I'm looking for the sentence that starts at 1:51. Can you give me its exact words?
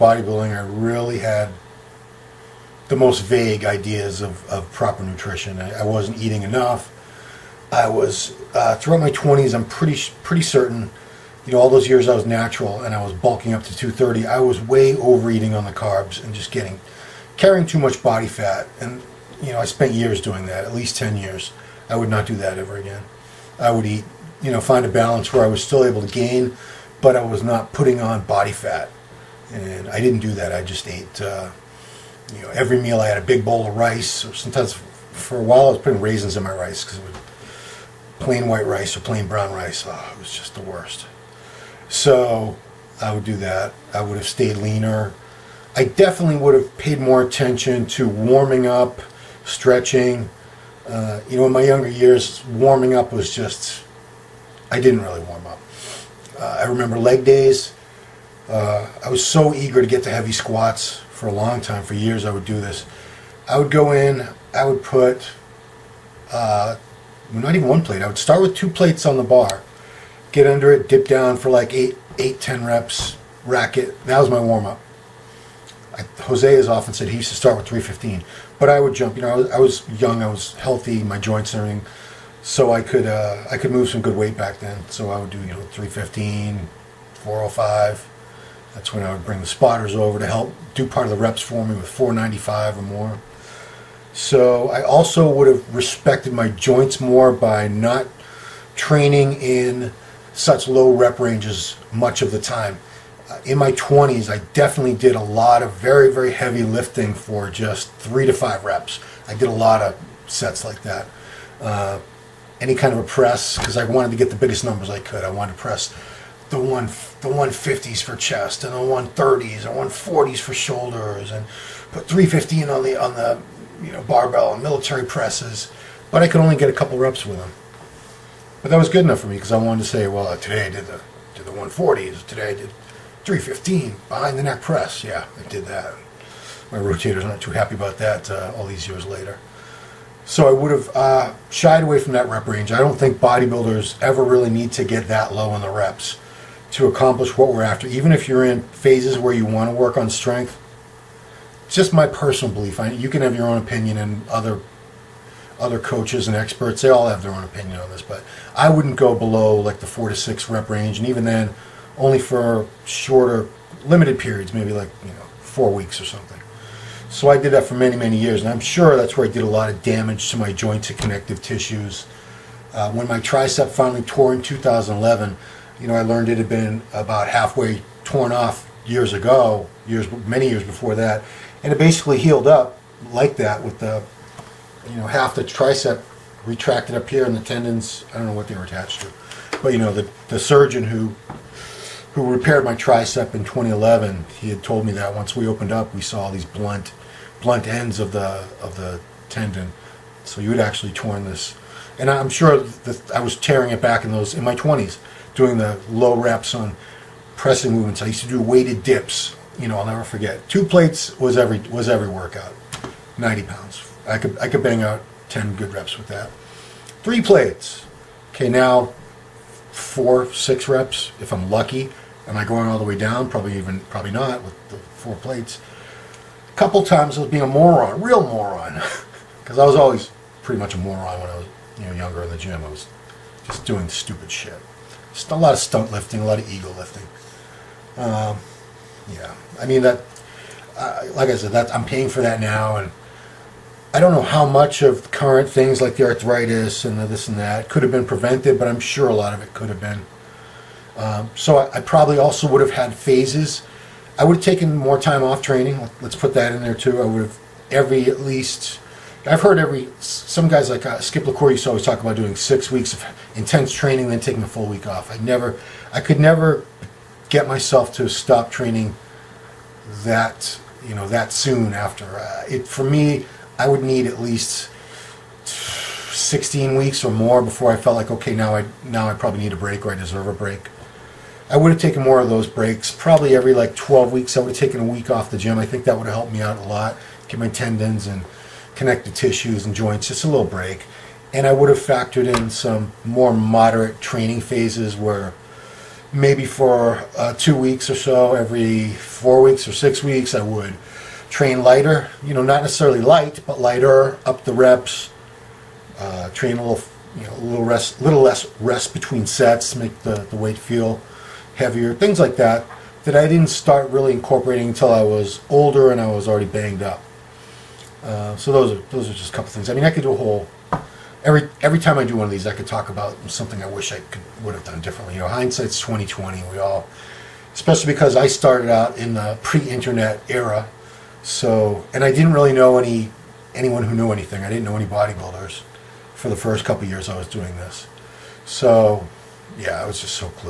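Uh, any kind of a press, because I wanted to get the biggest numbers I could.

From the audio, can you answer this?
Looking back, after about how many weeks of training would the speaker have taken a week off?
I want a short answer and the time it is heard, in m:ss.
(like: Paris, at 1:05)
12 weeks, at 4:43.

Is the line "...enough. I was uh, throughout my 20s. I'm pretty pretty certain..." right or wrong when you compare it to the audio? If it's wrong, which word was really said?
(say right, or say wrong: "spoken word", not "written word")
right.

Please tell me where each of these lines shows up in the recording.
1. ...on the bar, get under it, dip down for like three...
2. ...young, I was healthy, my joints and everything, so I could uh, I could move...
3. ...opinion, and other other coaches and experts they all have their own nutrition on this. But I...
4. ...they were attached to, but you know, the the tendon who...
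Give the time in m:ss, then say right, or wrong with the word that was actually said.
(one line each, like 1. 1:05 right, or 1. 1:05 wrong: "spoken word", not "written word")
1. 1:09 wrong: "eight", not "three"
2. 1:20 right
3. 2:33 wrong: "opinion", not "nutrition"
4. 3:08 wrong: "surgeon", not "tendon".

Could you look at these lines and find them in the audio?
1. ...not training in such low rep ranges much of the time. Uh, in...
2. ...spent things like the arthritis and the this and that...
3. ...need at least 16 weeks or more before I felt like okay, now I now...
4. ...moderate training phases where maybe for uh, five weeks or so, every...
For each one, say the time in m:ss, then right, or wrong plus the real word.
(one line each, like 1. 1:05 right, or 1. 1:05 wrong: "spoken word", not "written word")
1. 1:37 right
2. 4:05 wrong: "current", not "spent"
3. 4:33 right
4. 4:53 wrong: "two", not "five".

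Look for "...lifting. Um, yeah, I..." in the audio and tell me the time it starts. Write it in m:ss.
3:56.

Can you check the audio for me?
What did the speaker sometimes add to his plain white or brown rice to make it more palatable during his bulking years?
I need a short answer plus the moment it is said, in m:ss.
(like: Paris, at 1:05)
raisins, at 0:36.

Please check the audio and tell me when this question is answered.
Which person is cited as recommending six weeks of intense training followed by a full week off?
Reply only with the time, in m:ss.
4:21.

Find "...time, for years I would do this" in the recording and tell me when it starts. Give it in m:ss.
1:01.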